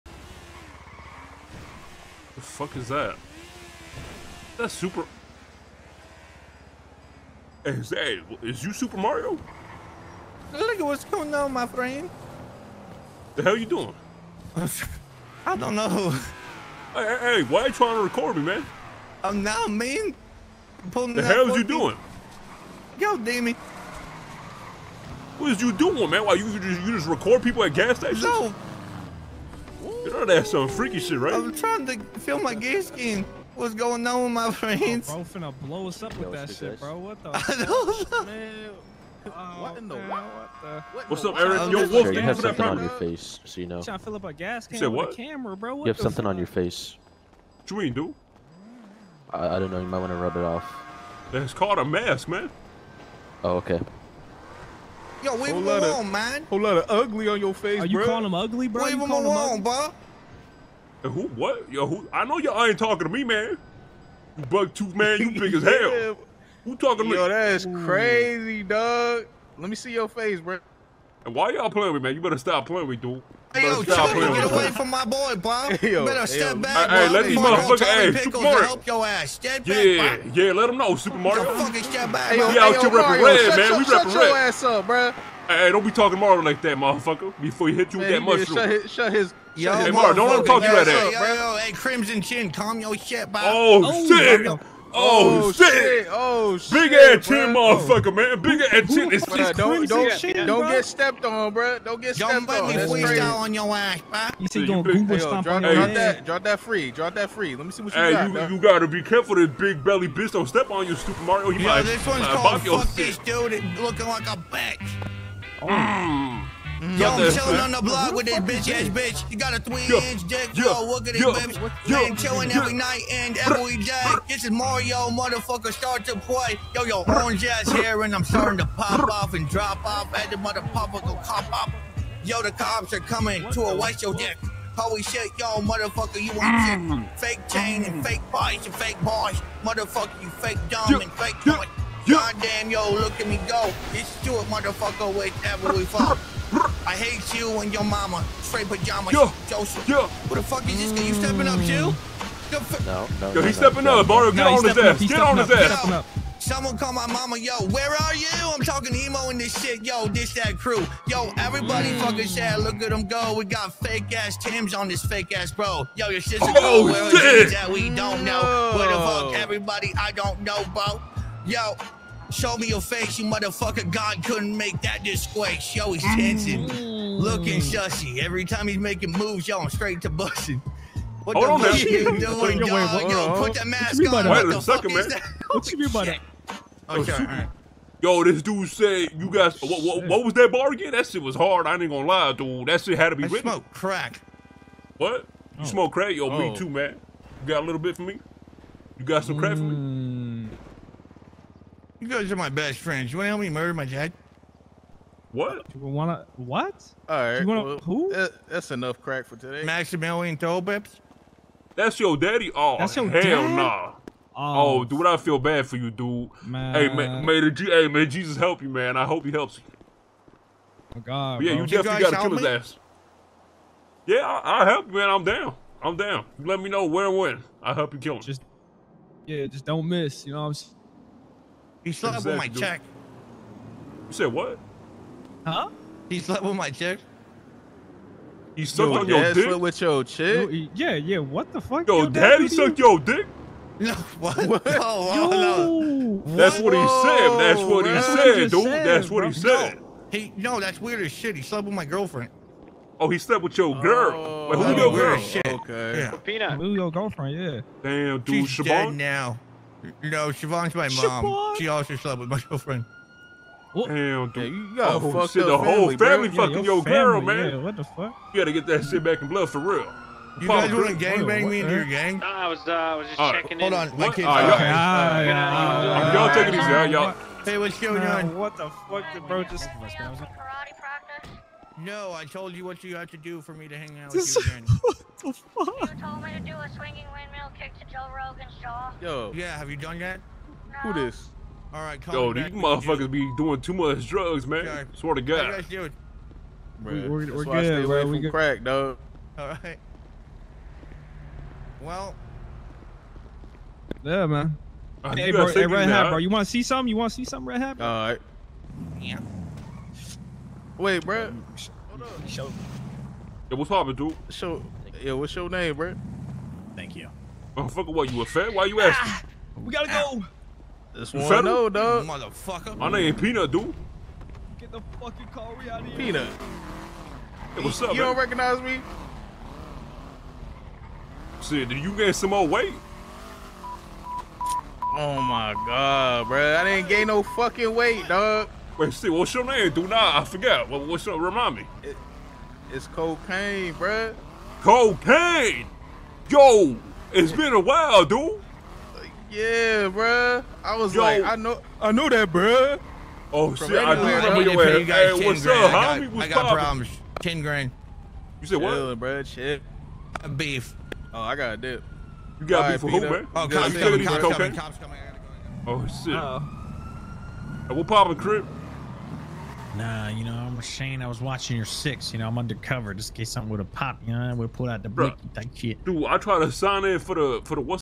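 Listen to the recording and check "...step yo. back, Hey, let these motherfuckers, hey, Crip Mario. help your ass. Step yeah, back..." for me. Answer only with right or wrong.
wrong.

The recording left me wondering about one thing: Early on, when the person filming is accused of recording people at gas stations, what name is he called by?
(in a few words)
Damien.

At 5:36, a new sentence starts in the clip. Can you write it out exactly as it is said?
I didn't gain no fucking weight, dog.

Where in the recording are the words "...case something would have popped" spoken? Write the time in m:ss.
6:13.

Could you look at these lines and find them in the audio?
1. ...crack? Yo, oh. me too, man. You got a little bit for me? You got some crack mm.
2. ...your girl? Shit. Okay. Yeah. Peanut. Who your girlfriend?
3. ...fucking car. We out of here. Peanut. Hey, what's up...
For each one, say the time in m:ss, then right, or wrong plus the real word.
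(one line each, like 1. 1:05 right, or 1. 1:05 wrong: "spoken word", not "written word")
1. 3:15 right
2. 4:14 right
3. 5:24 right.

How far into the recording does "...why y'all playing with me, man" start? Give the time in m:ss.
1:11.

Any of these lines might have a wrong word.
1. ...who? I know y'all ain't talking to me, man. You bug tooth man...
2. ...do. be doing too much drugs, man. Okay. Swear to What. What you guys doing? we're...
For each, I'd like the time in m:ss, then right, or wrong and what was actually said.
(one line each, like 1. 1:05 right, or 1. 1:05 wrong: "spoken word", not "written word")
1. 1:01 right
2. 4:52 wrong: "God", not "What".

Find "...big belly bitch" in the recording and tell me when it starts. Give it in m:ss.
1:49.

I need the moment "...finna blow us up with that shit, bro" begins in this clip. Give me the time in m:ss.
0:35.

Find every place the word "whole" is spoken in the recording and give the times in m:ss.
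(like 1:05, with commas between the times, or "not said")
0:56, 4:25.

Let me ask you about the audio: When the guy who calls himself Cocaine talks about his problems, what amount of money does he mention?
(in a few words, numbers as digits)
10 grand.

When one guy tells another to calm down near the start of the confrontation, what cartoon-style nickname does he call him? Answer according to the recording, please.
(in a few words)
Crimson Chin.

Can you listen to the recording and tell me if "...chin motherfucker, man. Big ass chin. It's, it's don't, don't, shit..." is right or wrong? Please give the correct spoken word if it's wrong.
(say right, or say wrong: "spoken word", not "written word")
right.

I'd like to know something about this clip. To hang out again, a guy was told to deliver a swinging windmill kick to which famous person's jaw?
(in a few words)
Joe Rogan.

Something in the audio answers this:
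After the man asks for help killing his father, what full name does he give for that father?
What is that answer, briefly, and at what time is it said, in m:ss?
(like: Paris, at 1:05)
Maximilian Tollbeps, at 3:29.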